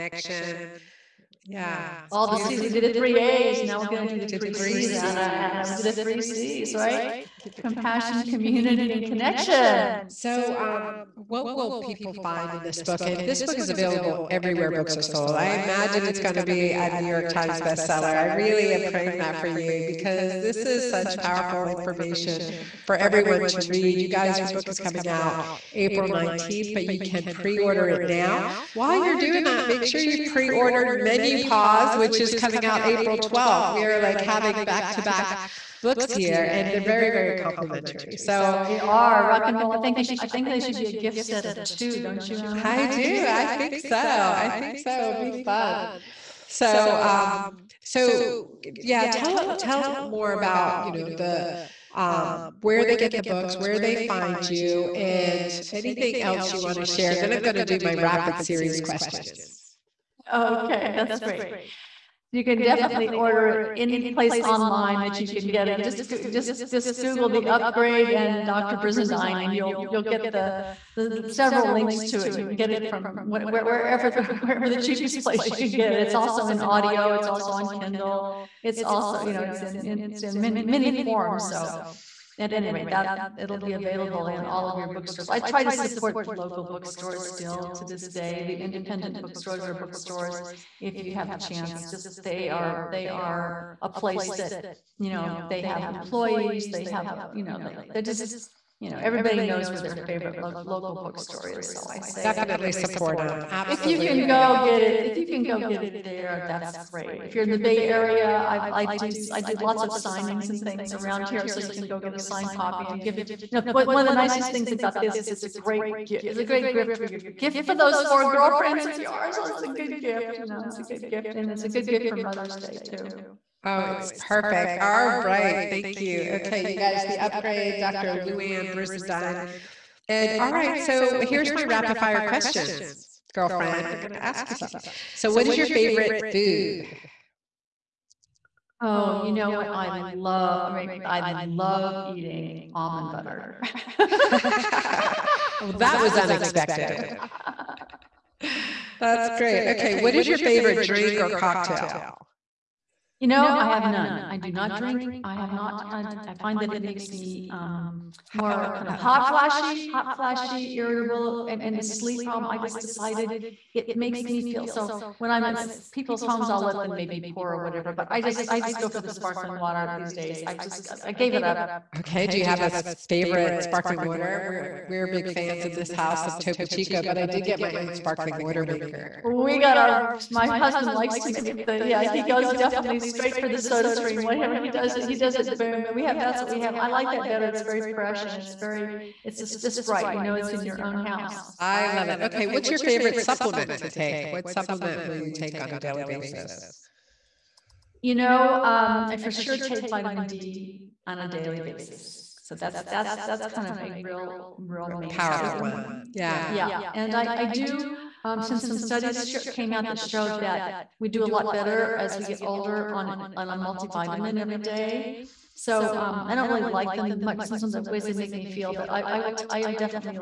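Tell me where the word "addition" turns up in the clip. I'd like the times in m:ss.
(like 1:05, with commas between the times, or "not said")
not said.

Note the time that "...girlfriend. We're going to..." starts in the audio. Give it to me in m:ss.
2:13.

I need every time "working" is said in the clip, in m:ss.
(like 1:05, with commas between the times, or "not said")
not said.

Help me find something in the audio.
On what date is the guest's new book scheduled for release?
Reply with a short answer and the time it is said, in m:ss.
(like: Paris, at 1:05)
April 19th, at 0:25.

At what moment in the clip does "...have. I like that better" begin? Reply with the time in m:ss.
3:06.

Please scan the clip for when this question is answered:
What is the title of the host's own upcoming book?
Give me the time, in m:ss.
0:30.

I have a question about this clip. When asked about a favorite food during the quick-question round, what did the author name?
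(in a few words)
almond butter.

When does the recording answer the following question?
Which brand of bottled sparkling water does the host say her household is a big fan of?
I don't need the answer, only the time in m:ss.
2:56.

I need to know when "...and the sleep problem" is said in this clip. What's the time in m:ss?
2:41.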